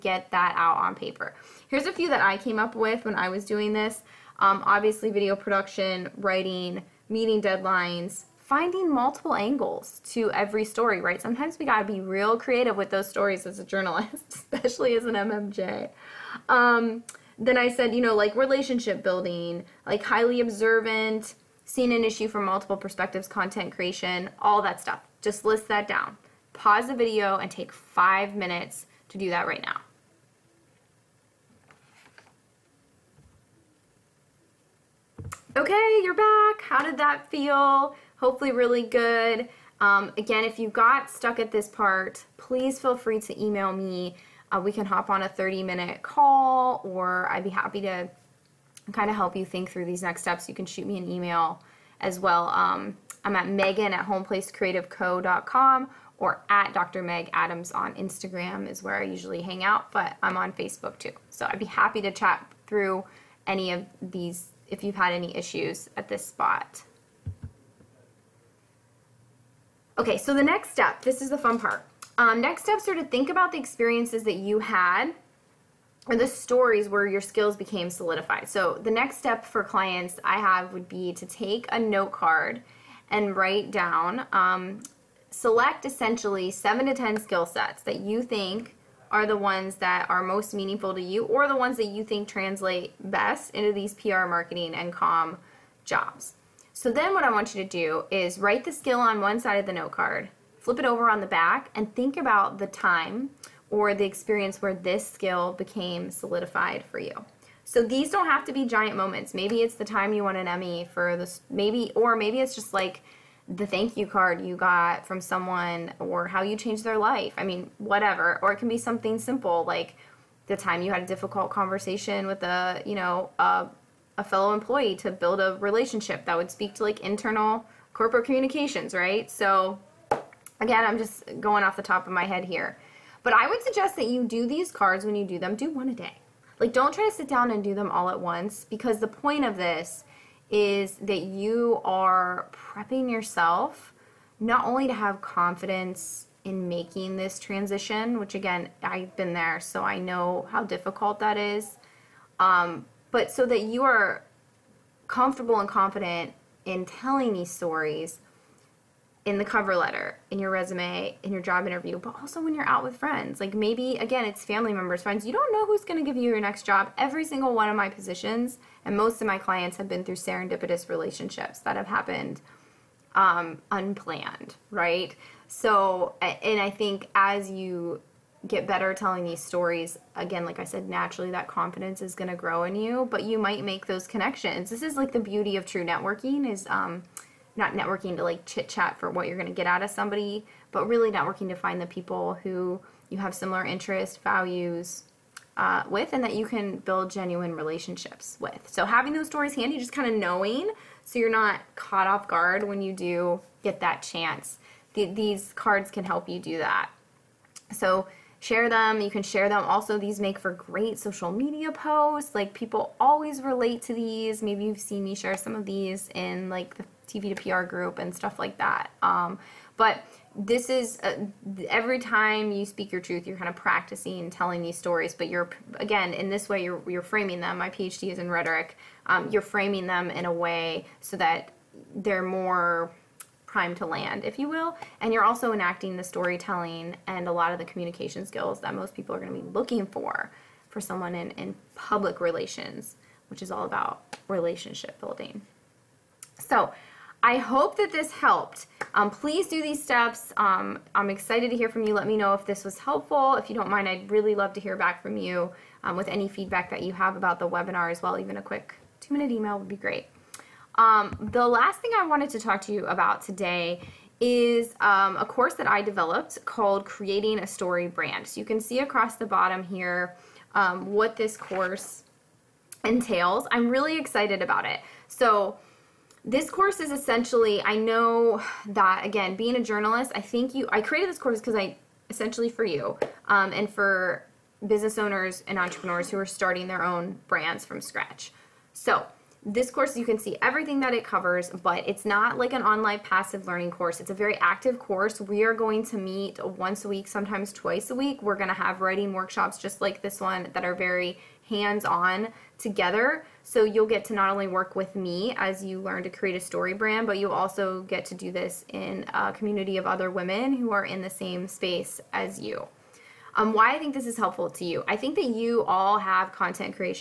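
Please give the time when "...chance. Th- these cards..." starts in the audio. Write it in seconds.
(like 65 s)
204 s.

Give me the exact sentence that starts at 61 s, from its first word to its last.
So I'd be happy to chat through any of these if you've had any issues at this spot.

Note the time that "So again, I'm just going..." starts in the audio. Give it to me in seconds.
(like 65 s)
129 s.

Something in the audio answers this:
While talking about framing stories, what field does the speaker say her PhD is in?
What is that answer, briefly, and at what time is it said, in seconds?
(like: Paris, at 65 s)
Rhetoric, at 228 s.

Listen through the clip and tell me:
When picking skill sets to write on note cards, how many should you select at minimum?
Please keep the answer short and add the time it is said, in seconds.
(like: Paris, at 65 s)
7, at 86 s.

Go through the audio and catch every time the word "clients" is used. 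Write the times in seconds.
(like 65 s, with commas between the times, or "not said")
79 s, 169 s.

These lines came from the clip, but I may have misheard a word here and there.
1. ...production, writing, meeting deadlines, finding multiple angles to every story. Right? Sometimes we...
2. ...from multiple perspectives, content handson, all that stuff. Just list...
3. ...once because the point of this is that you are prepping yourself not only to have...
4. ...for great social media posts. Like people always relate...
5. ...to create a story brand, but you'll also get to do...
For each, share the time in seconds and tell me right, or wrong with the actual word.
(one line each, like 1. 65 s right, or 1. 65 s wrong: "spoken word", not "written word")
1. 5 s right
2. 22 s wrong: "creation", not "handson"
3. 138 s right
4. 210 s right
5. 306 s right.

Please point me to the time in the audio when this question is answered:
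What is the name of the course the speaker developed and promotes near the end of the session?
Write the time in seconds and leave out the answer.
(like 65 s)
266 s.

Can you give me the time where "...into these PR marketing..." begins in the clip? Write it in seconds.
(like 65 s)
93 s.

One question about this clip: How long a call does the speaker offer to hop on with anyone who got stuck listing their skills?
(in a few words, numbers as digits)
30 minutes.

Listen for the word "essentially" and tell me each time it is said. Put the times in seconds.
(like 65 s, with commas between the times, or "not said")
85 s, 276 s, 282 s.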